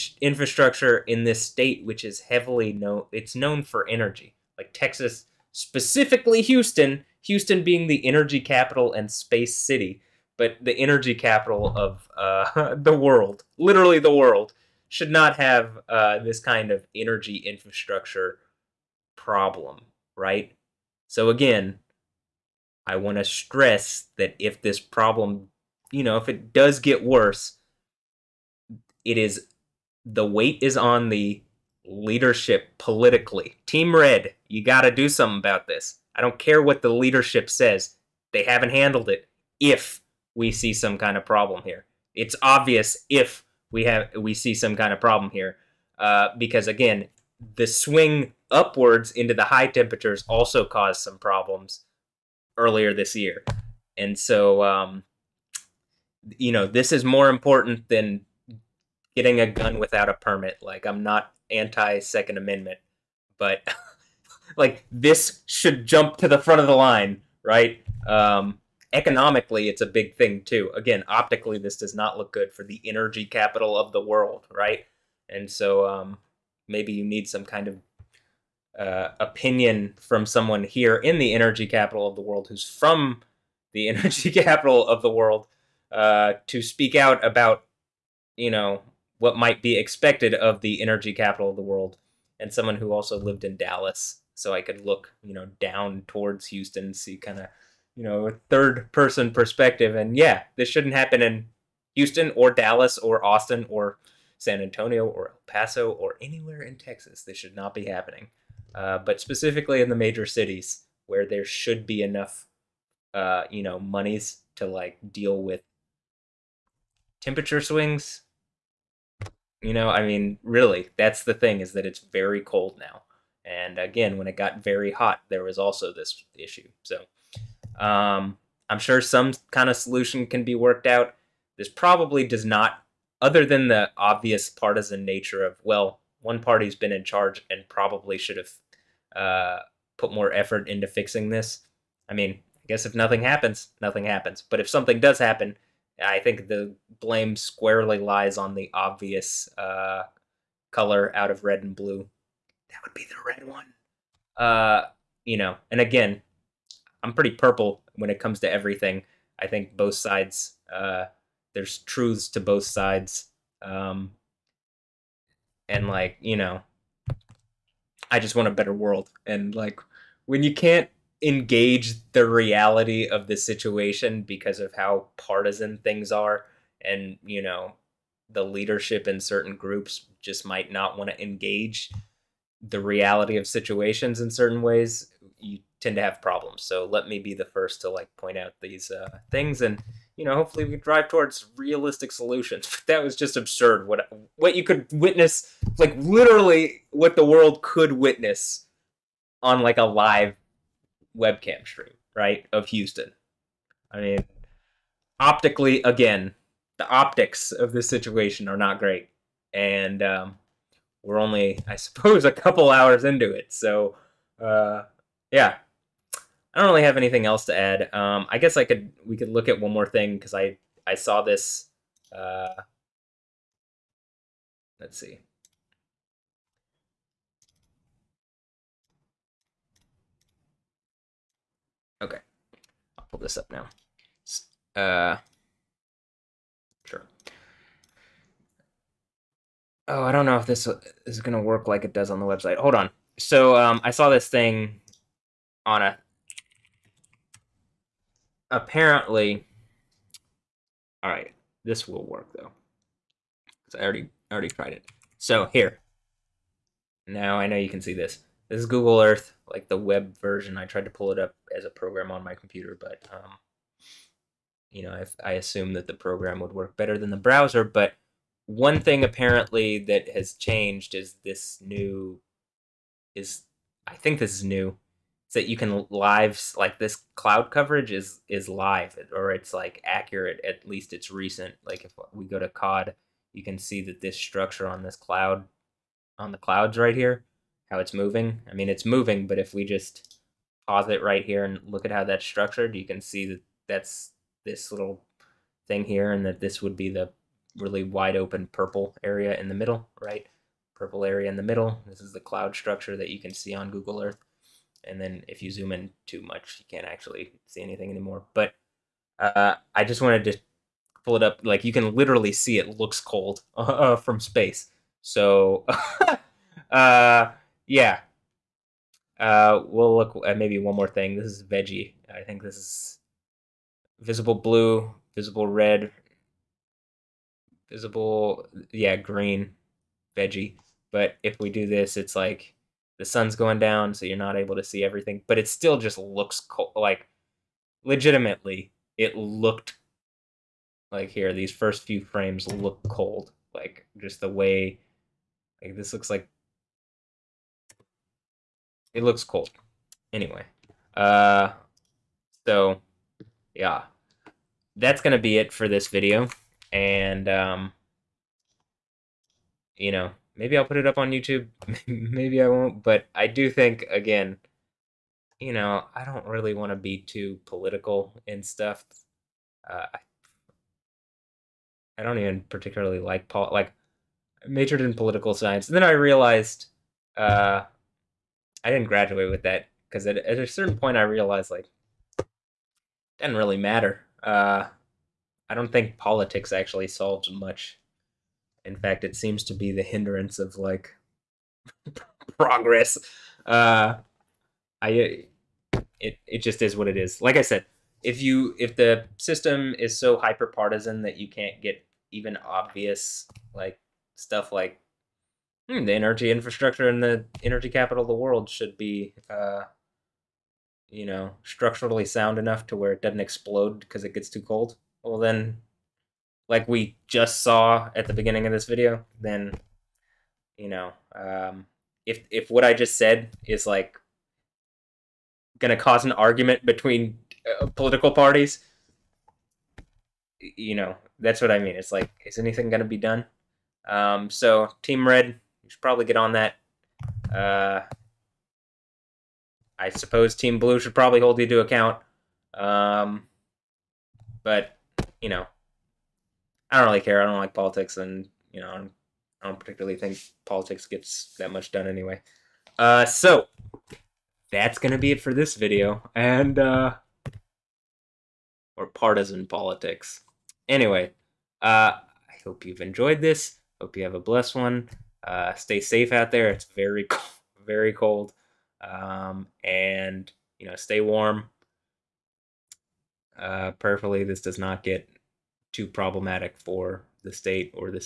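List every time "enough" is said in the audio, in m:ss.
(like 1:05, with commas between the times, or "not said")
1:52, 6:52.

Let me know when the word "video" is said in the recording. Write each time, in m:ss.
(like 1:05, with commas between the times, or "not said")
5:55, 6:58, 7:35.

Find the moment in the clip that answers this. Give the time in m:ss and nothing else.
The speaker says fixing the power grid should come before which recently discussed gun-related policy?
0:59.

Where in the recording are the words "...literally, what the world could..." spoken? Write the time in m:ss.
3:15.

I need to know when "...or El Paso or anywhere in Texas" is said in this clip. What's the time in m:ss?
1:45.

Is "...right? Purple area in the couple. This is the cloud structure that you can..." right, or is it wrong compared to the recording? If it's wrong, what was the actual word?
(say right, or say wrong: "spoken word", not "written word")
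wrong: "middle", not "couple".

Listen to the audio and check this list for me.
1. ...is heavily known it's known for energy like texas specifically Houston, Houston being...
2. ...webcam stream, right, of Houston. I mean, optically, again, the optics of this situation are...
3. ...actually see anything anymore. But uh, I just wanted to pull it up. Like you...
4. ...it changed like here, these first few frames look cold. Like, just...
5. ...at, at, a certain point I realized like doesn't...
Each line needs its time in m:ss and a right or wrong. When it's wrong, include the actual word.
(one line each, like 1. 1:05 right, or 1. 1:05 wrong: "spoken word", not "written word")
1. 0:02 right
2. 3:21 right
3. 5:06 right
4. 5:38 wrong: "looked", not "changed"
5. 6:20 right.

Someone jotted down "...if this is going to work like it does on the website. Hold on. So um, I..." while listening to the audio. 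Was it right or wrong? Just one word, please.
right.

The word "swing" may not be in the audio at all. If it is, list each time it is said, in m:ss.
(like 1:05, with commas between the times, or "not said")
0:47, 1:57.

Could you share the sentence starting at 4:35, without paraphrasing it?
Is that you can live like this cloud coverage is is live or it's like accurate at least it's recent.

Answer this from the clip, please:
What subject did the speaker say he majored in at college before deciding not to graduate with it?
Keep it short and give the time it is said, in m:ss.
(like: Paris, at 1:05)
Political science, at 6:14.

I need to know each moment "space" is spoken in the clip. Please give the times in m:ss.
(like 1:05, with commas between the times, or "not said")
0:09, 5:14.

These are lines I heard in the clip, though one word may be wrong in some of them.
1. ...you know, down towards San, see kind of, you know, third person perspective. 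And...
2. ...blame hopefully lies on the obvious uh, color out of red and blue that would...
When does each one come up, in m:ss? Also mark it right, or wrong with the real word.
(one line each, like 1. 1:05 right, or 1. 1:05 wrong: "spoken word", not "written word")
1. 1:35 wrong: "Houston", not "San"
2. 2:26 wrong: "squarely", not "hopefully".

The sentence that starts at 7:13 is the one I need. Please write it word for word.
Um, so, Team Red, you should probably get on that.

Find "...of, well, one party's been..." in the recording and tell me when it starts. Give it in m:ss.
2:15.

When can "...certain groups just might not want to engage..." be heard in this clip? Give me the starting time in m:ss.
2:59.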